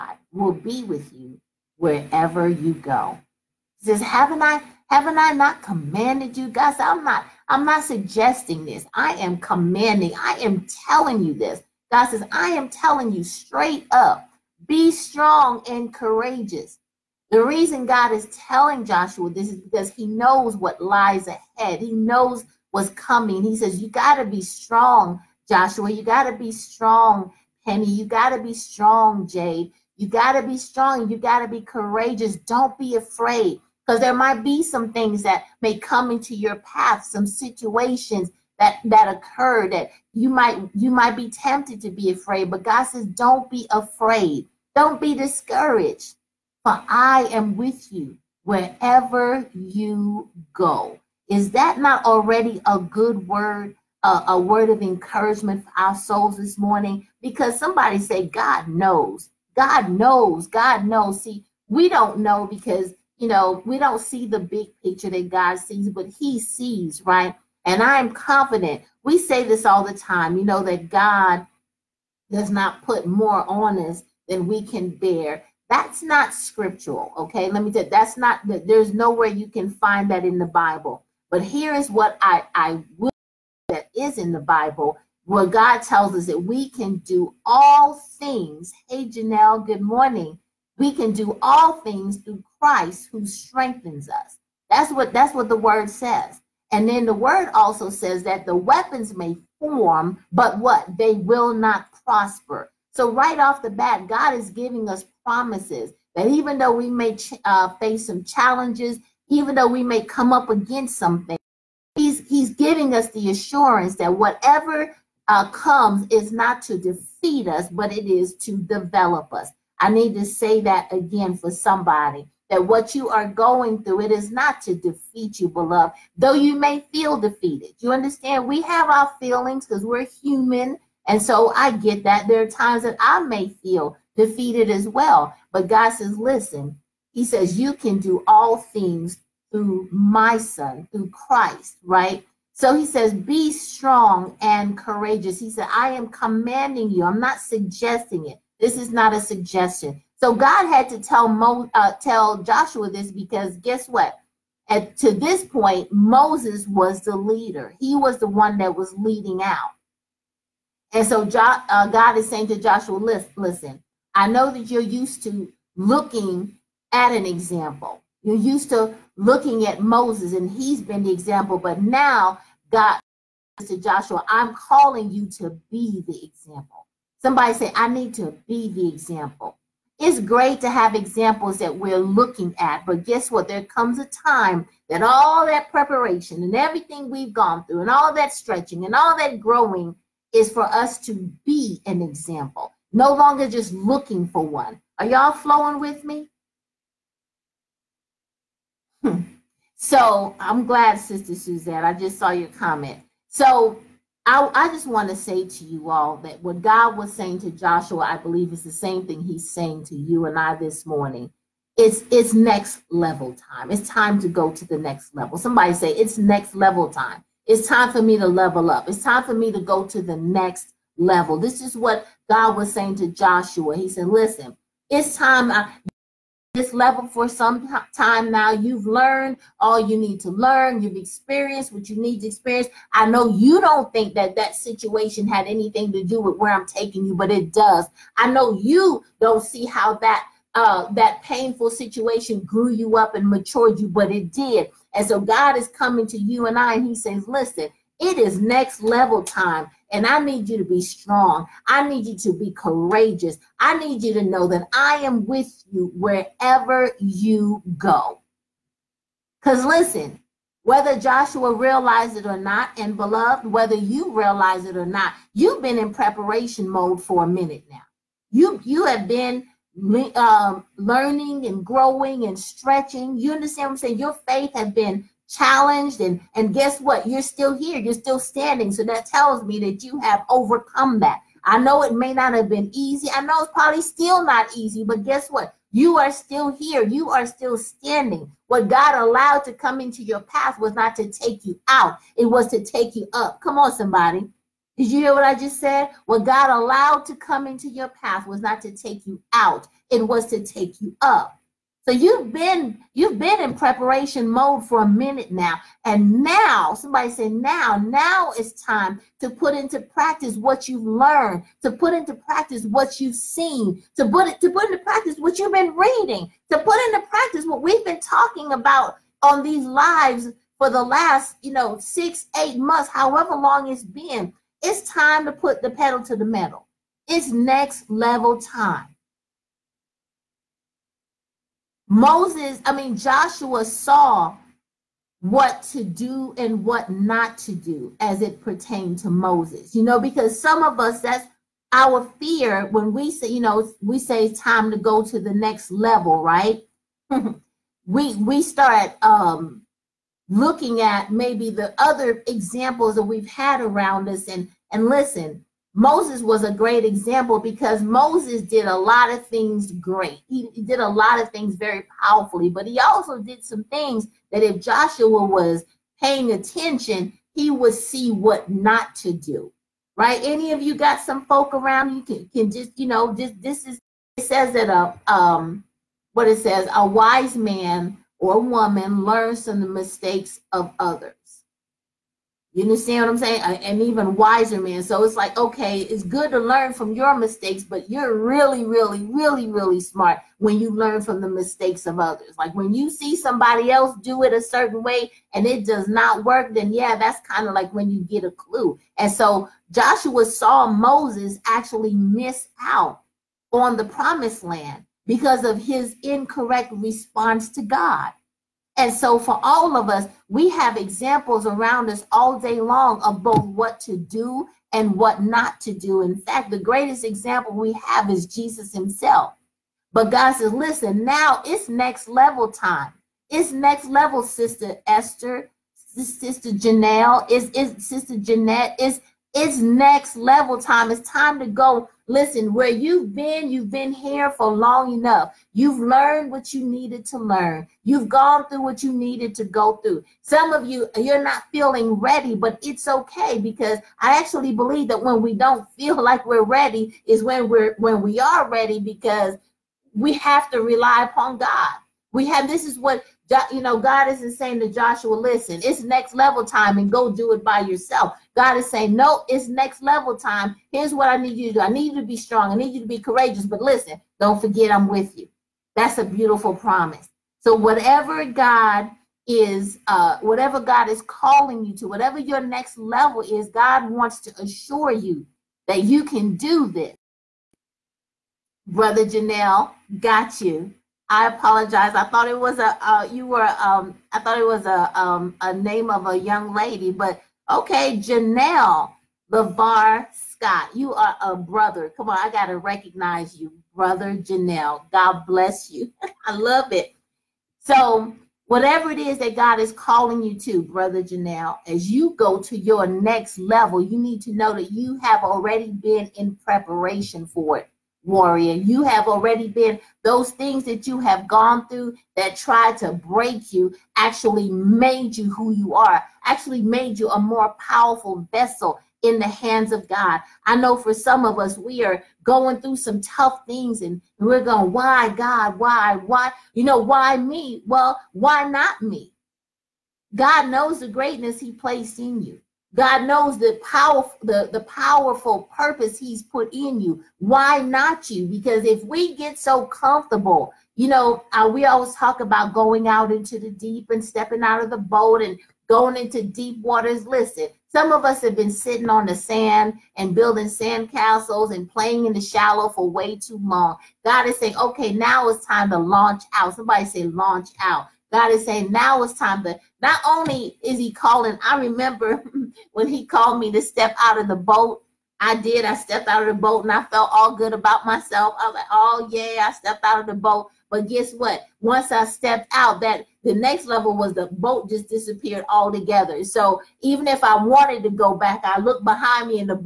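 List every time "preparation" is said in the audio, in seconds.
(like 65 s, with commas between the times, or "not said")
185 s, 265 s, 303 s, 506 s.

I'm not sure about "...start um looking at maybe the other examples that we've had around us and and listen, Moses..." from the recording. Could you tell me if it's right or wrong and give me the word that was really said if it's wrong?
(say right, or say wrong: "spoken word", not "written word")
right.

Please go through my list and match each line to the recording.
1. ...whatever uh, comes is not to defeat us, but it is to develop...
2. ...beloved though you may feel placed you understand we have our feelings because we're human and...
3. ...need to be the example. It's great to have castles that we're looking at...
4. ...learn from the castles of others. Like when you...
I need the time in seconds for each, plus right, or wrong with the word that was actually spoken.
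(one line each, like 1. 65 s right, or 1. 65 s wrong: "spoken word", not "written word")
1. 114 s right
2. 125 s wrong: "defeated", not "placed"
3. 177 s wrong: "examples", not "castles"
4. 390 s wrong: "mistakes", not "castles".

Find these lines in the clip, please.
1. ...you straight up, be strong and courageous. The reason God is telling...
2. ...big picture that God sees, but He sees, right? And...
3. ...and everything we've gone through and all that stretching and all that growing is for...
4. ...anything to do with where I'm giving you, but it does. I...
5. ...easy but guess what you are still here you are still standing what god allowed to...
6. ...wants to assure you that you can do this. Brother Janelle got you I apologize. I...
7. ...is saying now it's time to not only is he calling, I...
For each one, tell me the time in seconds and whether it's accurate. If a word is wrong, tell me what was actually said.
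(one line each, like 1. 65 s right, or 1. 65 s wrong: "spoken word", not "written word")
1. 13 s right
2. 64 s right
3. 186 s right
4. 235 s wrong: "taking", not "giving"
5. 284 s right
6. 473 s right
7. 558 s right.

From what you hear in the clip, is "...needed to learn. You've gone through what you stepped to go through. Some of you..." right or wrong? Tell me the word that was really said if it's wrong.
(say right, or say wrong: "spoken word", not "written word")
wrong: "needed", not "stepped".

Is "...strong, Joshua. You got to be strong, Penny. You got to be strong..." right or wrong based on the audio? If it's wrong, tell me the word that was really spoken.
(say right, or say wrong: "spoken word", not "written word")
right.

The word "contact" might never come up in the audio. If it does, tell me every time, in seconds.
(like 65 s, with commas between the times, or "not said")
not said.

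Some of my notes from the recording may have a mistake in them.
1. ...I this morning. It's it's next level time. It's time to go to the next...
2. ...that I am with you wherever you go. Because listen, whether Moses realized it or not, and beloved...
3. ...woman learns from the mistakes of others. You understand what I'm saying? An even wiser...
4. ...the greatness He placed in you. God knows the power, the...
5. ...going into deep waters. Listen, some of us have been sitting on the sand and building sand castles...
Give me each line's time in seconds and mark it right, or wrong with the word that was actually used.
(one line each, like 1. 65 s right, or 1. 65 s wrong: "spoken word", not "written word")
1. 210 s right
2. 254 s wrong: "Joshua", not "Moses"
3. 378 s right
4. 530 s right
5. 545 s right.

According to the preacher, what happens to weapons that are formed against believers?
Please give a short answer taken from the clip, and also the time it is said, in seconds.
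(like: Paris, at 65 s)
They will not prosper, at 100 s.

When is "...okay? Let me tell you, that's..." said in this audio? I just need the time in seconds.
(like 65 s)
77 s.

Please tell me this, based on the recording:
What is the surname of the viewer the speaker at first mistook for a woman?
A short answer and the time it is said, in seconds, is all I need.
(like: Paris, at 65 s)
Scott, at 487 s.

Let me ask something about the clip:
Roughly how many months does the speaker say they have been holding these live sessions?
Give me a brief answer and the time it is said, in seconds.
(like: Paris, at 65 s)
six, eight months, at 321 s.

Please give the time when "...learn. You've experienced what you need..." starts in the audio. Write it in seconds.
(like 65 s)
230 s.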